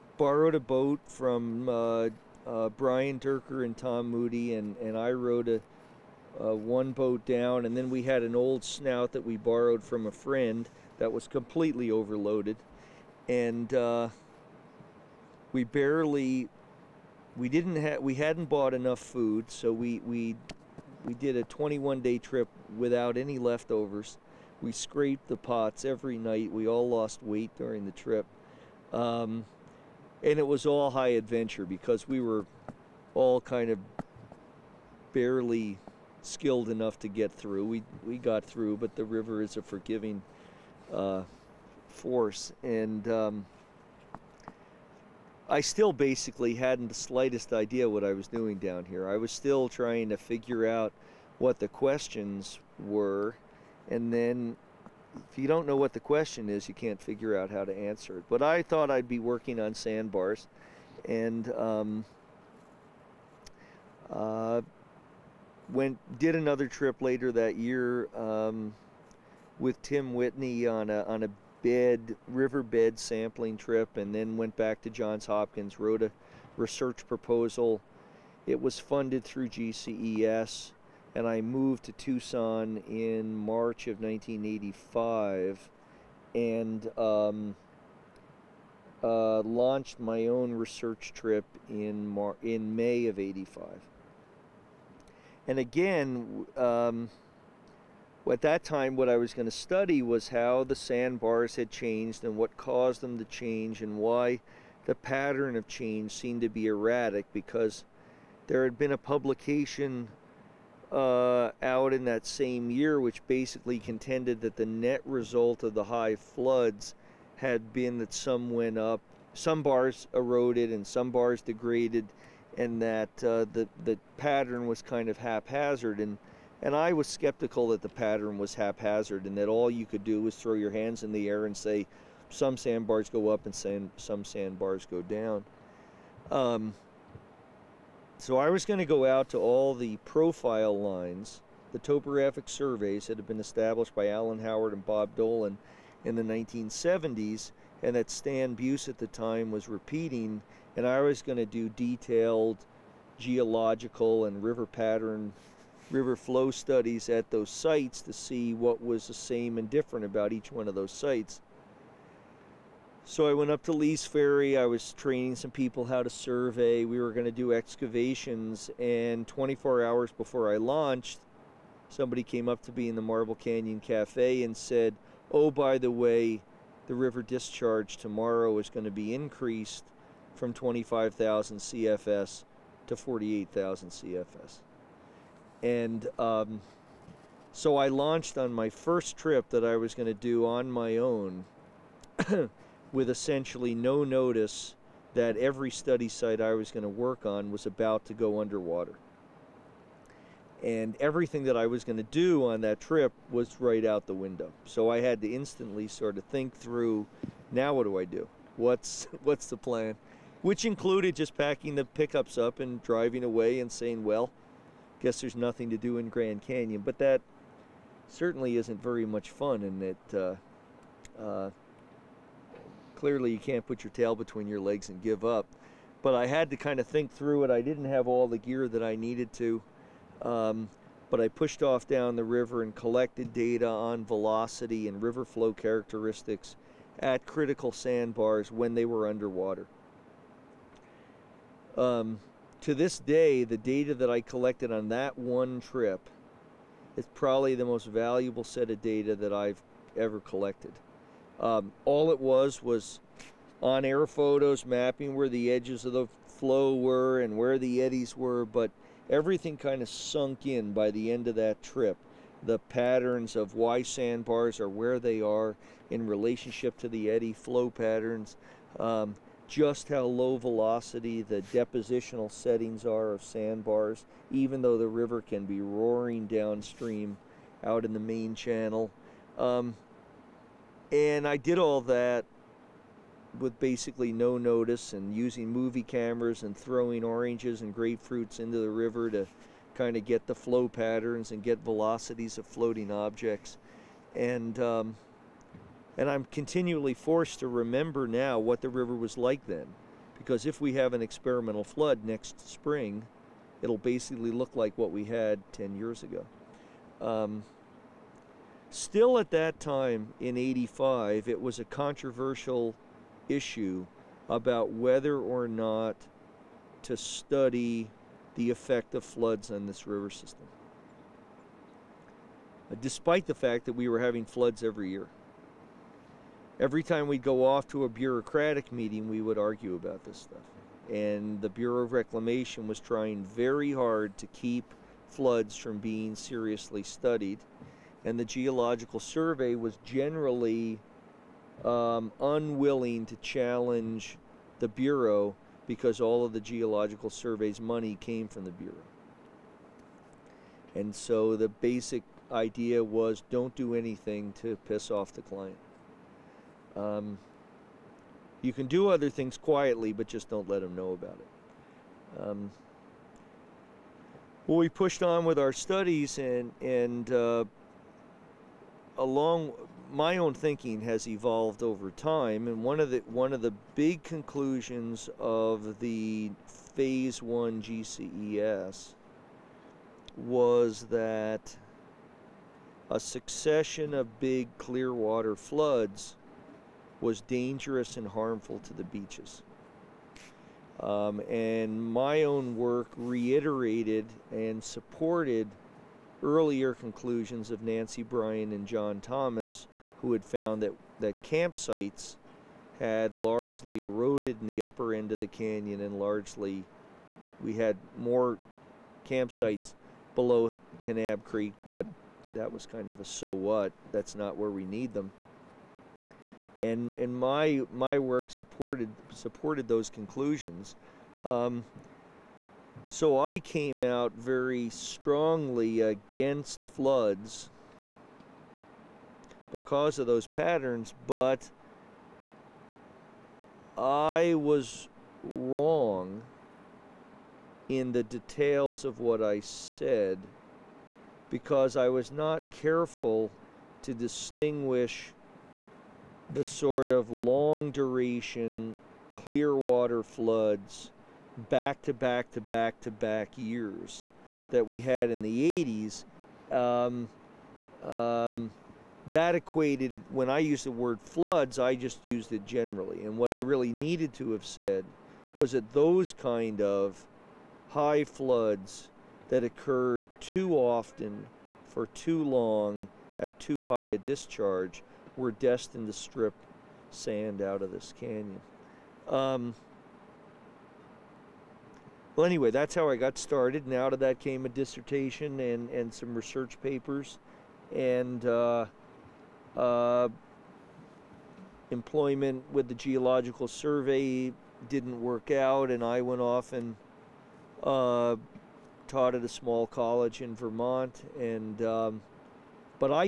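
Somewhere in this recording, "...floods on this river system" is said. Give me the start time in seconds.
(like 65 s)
319 s.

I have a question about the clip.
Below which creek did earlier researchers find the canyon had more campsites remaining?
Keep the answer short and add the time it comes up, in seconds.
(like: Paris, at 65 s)
Kanab Creek, at 410 s.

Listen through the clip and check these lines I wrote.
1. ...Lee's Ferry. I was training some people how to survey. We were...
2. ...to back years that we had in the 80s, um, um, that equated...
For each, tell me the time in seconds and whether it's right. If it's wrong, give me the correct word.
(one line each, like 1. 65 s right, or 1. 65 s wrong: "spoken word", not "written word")
1. 163 s right
2. 452 s right.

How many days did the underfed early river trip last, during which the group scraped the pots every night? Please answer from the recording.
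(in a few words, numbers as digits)
21.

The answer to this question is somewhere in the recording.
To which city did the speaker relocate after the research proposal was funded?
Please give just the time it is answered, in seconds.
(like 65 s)
81 s.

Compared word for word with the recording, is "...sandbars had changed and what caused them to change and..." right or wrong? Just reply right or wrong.
right.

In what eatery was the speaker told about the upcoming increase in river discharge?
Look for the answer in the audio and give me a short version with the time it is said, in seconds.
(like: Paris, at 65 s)
Marble Canyon Cafe, at 173 s.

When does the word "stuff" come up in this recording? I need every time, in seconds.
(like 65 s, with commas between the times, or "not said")
330 s.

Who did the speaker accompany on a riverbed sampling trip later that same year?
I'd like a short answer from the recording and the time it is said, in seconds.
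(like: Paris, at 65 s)
Tim Whitney, at 69 s.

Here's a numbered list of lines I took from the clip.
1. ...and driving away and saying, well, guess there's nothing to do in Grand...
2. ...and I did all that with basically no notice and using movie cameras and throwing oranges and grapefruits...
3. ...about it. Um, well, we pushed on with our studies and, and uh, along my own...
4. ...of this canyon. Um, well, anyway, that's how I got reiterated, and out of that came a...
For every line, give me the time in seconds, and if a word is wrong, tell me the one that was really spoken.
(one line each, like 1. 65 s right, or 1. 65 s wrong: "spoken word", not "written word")
1. 212 s right
2. 280 s right
3. 360 s right
4. 477 s wrong: "started", not "reiterated".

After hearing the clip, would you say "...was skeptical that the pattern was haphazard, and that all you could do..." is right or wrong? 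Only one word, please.
right.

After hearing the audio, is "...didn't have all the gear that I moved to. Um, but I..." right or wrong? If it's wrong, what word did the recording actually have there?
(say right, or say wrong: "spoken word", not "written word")
wrong: "needed", not "moved".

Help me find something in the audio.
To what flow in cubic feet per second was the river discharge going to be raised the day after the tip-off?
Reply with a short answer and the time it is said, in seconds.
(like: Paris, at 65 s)
48,000 CFS, at 182 s.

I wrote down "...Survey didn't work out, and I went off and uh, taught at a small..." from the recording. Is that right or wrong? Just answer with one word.
right.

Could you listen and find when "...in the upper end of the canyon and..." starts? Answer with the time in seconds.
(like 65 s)
404 s.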